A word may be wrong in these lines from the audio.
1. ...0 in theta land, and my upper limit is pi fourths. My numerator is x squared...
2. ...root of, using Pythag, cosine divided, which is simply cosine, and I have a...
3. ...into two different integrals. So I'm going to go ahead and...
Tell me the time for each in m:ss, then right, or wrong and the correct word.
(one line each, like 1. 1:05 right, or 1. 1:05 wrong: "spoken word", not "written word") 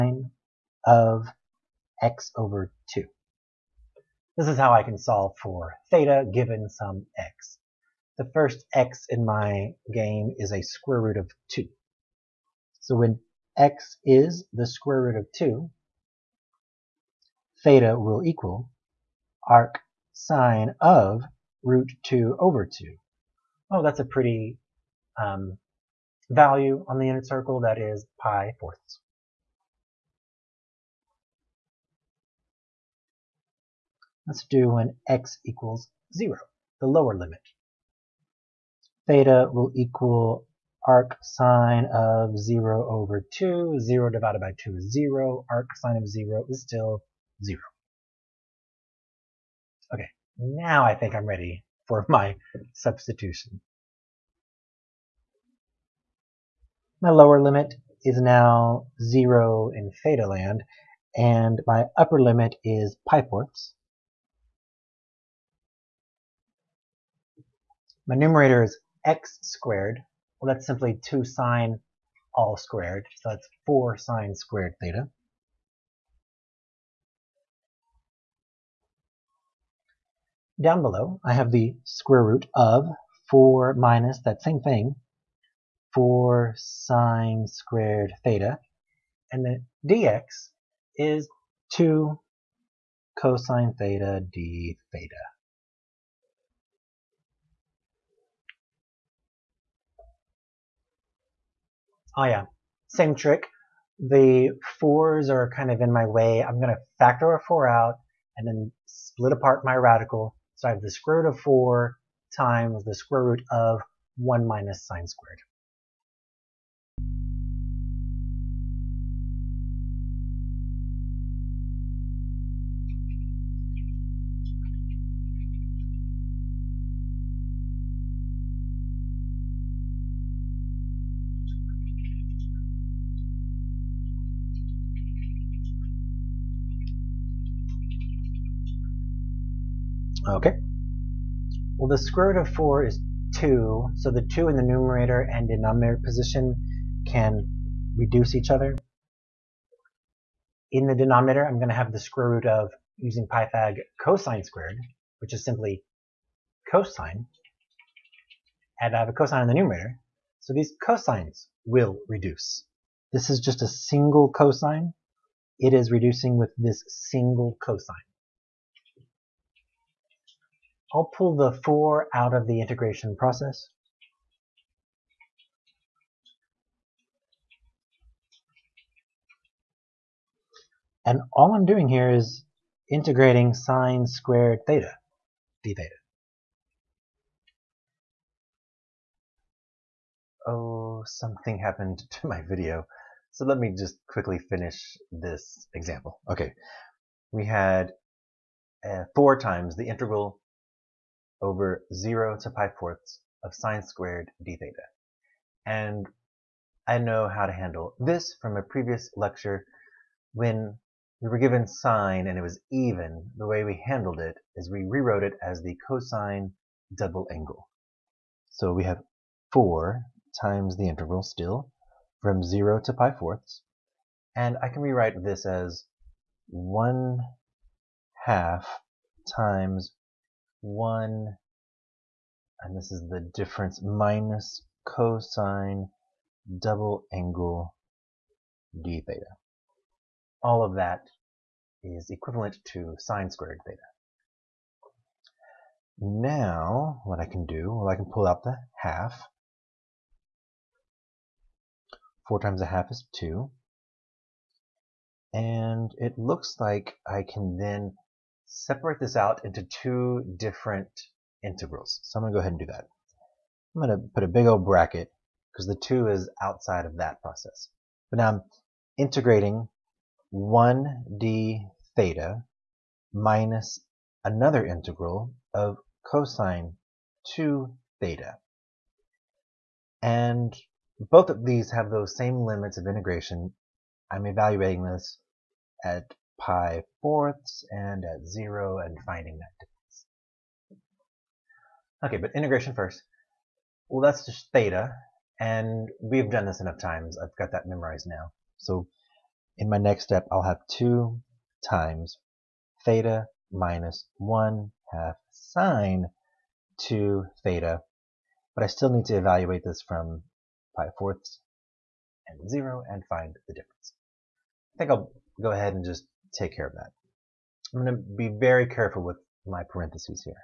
1. 0:59 right
2. 2:32 wrong: "squared", not "divided"
3. 4:19 right.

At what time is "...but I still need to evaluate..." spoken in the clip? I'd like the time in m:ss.
5:08.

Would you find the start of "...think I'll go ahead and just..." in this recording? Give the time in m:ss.
5:14.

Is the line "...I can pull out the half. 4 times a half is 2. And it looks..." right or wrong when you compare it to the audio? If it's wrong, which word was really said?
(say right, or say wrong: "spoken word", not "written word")
right.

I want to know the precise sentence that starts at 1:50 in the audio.
So I have the square root of four times the square root of one minus sine squared.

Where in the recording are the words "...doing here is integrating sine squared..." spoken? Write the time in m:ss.
3:01.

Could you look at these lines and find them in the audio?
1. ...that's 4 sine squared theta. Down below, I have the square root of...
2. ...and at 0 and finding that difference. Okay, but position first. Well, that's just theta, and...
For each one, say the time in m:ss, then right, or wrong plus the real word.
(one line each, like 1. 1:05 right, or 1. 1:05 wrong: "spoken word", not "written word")
1. 1:13 right
2. 4:47 wrong: "integration", not "position".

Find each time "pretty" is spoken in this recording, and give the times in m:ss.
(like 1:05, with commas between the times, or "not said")
0:24.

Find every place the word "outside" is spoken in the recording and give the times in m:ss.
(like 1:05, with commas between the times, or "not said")
4:26.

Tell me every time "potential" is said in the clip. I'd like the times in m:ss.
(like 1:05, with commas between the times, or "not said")
not said.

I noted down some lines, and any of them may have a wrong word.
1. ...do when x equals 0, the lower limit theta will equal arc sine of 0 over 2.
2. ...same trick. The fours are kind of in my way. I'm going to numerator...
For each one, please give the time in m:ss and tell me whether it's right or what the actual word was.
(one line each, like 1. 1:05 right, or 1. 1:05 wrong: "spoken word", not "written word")
1. 0:34 right
2. 1:42 wrong: "factor", not "numerator".